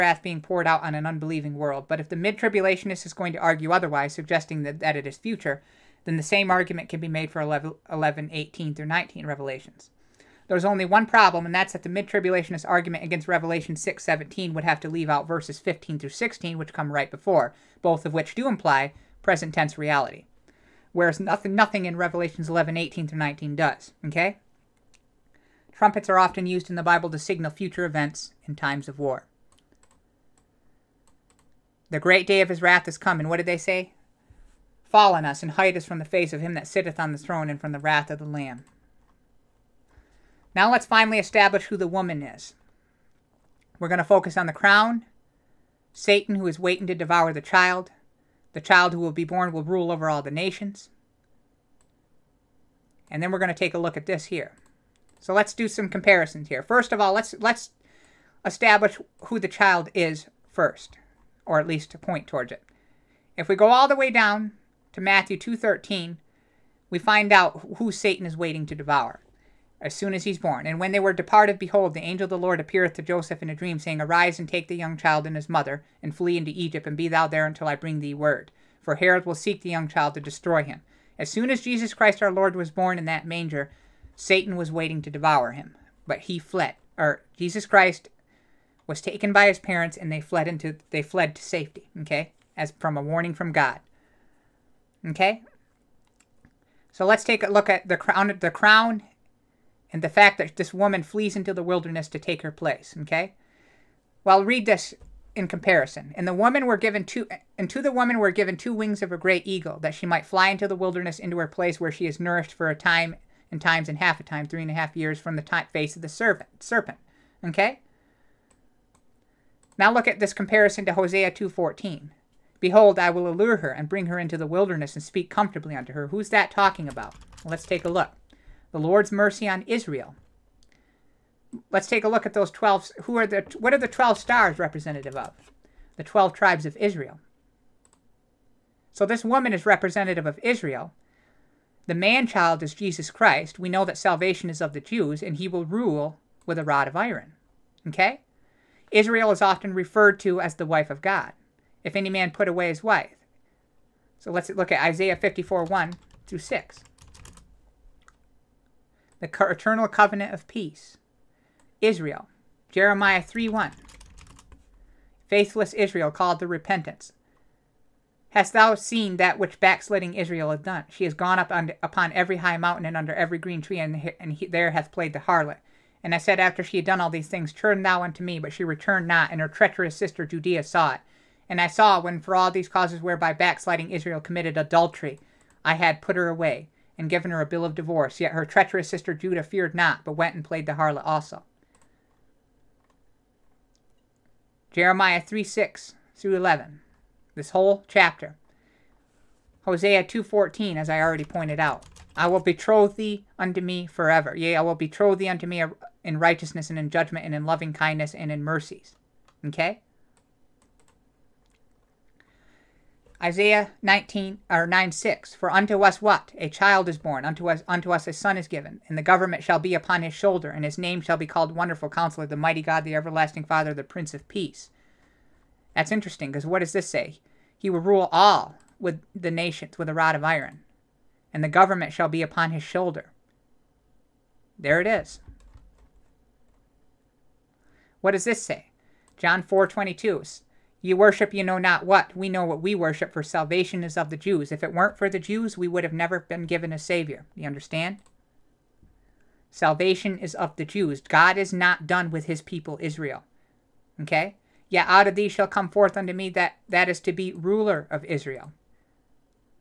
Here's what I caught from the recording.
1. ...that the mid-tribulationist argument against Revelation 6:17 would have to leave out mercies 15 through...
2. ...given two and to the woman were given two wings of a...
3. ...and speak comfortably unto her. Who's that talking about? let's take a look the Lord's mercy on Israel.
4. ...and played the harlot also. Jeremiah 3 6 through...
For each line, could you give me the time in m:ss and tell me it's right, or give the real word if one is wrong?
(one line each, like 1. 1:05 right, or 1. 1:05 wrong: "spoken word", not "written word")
1. 0:11 wrong: "verses", not "mercies"
2. 1:46 right
3. 2:04 right
4. 3:10 right.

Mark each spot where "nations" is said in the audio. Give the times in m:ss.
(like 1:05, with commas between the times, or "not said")
0:50, 3:49.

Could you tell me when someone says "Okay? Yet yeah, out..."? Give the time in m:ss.
4:13.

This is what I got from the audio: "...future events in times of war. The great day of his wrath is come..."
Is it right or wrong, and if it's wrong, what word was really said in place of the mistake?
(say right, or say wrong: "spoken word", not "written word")
right.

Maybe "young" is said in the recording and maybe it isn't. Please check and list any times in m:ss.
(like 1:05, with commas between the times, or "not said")
1:14, 1:19.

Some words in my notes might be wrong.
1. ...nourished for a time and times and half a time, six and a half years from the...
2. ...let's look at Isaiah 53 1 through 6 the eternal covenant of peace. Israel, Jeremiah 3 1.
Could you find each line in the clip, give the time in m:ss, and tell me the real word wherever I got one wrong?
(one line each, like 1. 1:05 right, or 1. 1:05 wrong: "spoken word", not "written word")
1. 1:52 wrong: "three", not "six"
2. 2:34 wrong: "54", not "53".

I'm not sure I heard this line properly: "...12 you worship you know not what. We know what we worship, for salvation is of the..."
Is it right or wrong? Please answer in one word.
wrong.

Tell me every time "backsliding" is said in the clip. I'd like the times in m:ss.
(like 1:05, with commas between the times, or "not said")
2:49, 3:03.